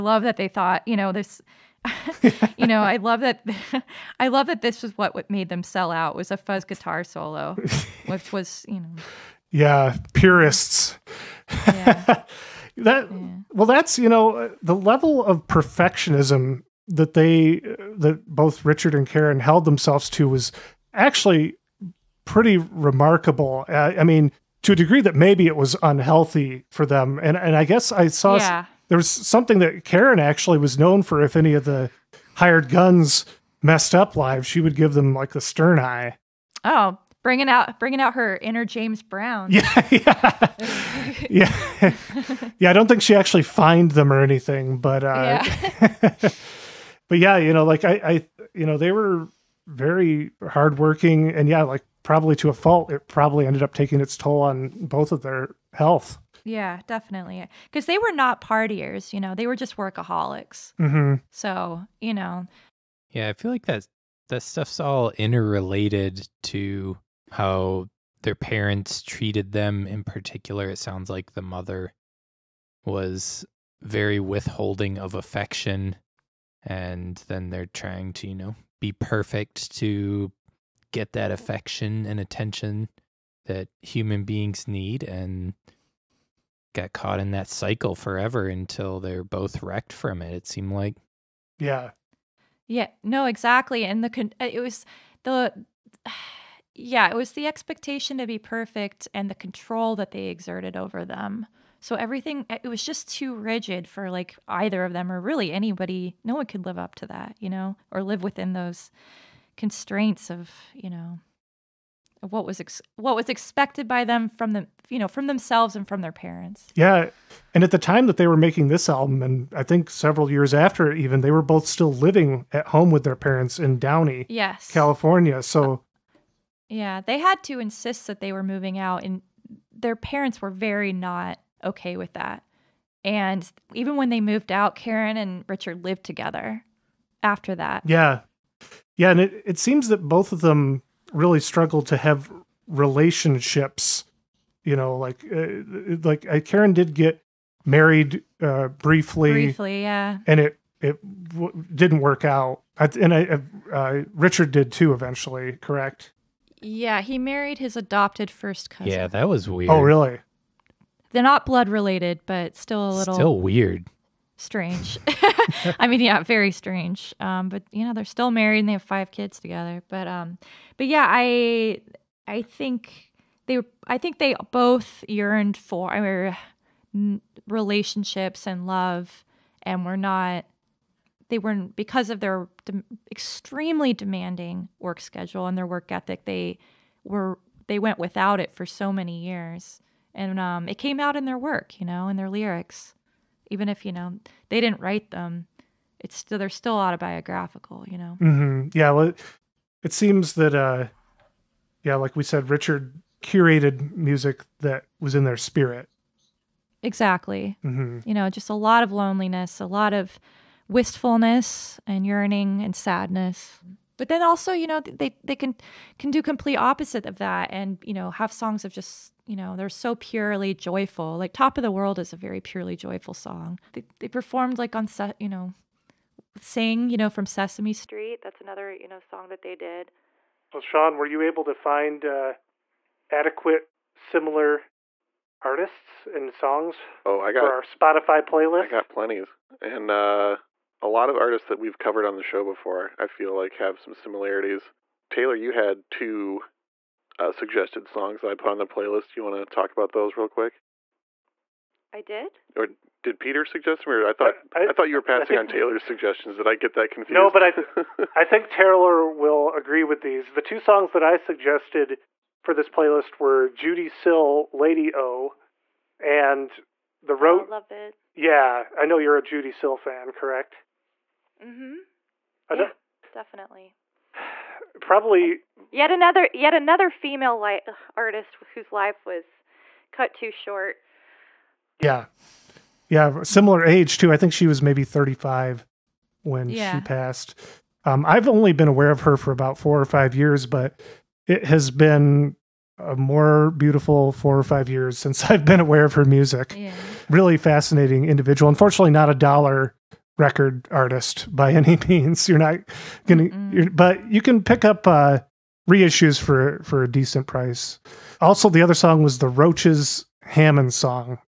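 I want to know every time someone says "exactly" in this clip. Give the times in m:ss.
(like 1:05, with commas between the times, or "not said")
1:33, 3:26.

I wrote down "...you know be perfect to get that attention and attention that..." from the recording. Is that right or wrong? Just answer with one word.
wrong.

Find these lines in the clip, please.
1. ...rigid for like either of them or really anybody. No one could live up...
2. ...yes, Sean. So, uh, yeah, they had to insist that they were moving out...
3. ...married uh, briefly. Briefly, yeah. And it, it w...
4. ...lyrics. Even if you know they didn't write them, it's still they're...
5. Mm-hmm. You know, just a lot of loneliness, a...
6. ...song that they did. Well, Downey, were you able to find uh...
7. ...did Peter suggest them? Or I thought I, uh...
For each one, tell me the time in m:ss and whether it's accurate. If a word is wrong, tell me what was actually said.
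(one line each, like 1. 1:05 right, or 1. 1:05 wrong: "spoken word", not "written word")
1. 1:43 right
2. 2:04 wrong: "California", not "Sean"
3. 2:27 right
4. 3:12 right
5. 3:27 right
6. 3:48 wrong: "Sean", not "Downey"
7. 4:13 right.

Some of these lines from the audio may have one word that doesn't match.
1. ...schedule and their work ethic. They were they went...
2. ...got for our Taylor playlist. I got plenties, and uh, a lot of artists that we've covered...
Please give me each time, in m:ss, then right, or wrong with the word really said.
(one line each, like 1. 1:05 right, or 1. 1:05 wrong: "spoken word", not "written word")
1. 3:04 right
2. 3:57 wrong: "Spotify", not "Taylor".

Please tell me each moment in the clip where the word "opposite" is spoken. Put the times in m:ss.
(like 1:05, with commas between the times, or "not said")
3:36.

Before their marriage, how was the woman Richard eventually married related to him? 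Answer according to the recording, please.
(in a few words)
Adopted first cousin.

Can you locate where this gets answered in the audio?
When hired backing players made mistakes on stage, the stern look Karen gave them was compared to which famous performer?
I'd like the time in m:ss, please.
0:38.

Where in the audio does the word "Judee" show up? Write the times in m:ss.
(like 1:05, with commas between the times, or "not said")
4:23, 4:29.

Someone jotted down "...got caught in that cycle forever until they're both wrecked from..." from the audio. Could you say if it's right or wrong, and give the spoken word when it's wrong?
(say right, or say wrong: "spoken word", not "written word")
right.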